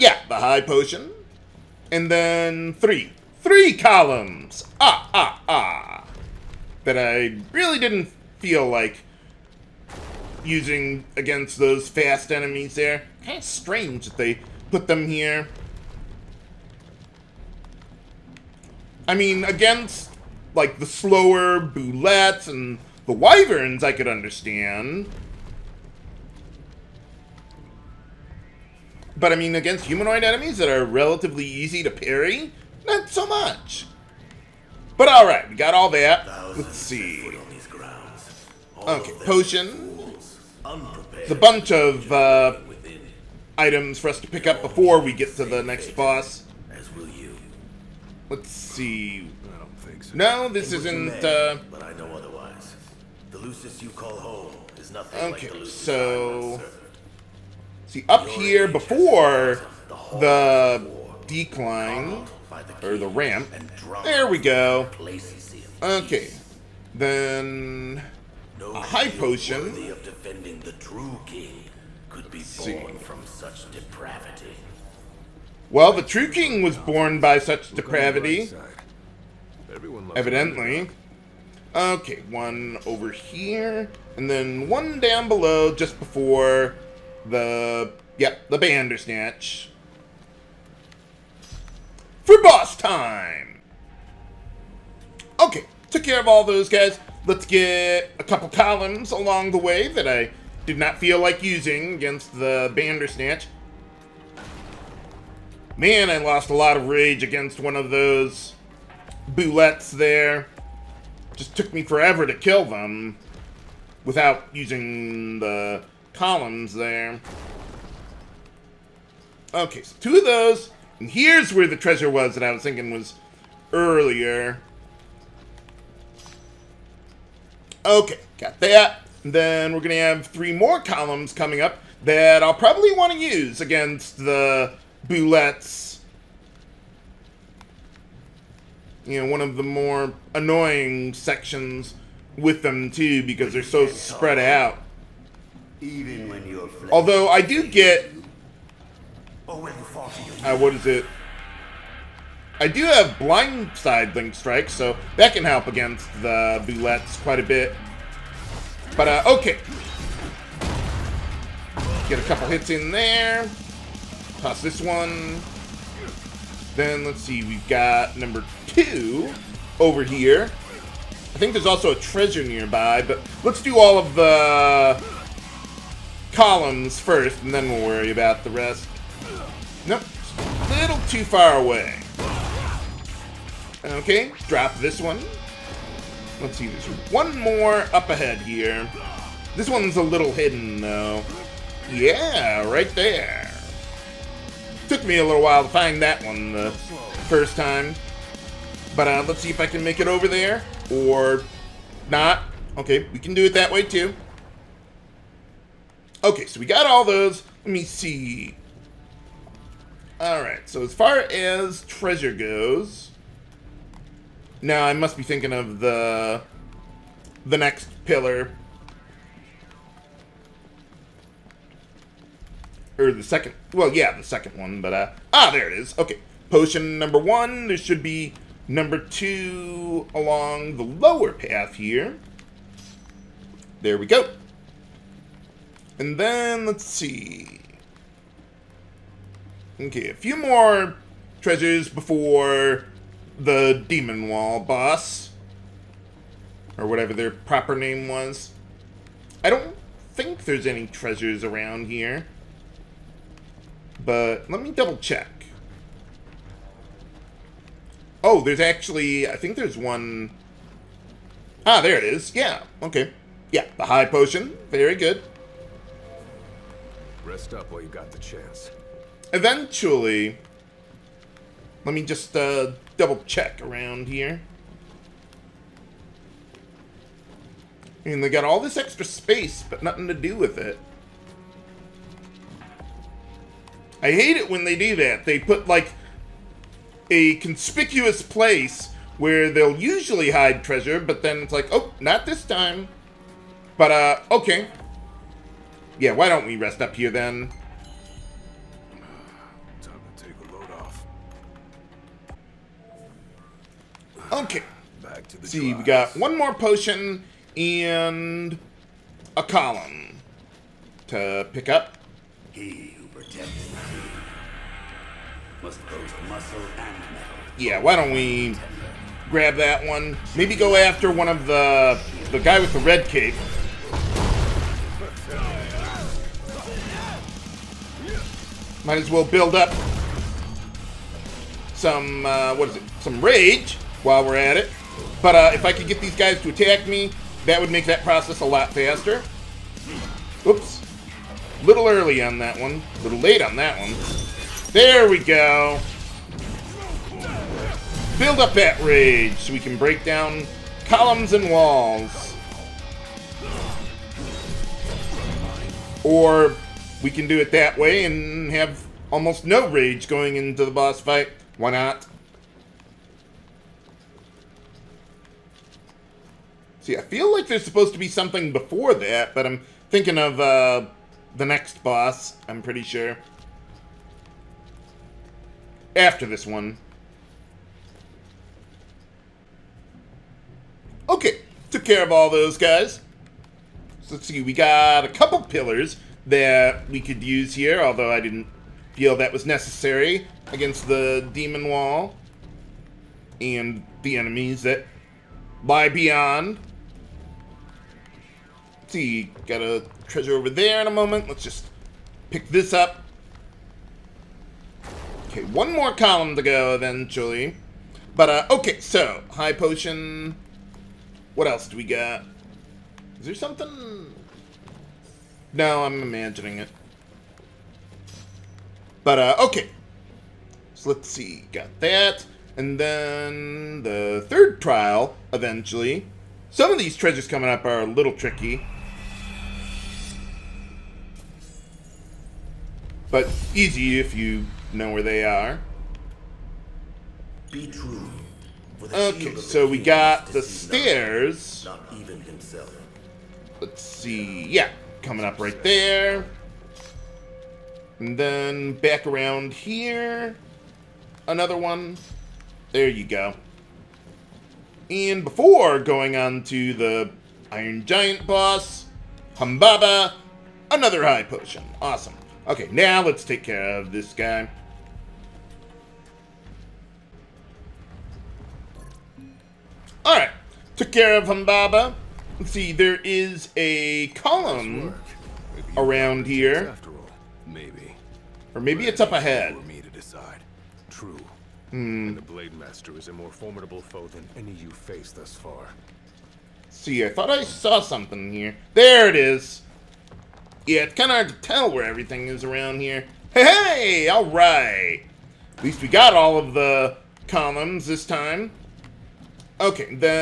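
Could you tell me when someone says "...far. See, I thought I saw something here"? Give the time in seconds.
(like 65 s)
485 s.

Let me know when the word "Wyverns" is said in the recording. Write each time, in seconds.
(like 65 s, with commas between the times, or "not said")
23 s.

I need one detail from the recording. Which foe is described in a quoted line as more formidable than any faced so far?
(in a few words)
the Blade Master.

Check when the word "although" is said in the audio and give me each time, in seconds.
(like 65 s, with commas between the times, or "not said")
146 s, 387 s.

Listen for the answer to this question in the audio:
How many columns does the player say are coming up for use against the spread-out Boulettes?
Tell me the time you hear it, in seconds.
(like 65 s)
130 s.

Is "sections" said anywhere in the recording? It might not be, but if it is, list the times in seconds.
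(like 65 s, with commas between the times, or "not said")
141 s.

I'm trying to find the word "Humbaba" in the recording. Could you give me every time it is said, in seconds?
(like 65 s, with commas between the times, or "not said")
459 s, 471 s.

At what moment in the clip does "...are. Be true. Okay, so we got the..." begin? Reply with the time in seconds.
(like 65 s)
435 s.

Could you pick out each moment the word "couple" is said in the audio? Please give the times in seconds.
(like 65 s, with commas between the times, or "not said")
98 s, 162 s, 385 s.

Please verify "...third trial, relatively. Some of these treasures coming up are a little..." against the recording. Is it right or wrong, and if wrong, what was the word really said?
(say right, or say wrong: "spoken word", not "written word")
wrong: "eventually", not "relatively".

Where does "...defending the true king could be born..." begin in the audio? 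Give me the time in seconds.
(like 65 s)
70 s.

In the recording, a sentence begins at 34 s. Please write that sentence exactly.
But, alright, we got all that.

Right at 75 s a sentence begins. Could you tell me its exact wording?
Well, the true king was born by such depravity.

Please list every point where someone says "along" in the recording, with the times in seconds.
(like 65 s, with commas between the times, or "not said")
99 s, 230 s.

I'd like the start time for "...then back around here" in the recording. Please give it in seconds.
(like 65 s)
448 s.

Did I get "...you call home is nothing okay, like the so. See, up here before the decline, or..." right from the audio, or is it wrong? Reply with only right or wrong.
right.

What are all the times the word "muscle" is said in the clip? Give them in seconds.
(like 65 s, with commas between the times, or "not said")
316 s.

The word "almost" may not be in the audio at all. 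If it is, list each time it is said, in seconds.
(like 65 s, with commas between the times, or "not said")
359 s.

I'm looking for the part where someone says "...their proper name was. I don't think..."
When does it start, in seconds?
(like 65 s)
247 s.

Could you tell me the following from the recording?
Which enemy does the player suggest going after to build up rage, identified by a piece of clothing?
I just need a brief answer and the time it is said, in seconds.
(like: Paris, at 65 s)
the guy with the red cape, at 322 s.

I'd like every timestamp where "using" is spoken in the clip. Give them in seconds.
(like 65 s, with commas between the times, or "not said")
10 s, 101 s, 114 s.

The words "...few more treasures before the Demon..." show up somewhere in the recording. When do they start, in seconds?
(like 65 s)
240 s.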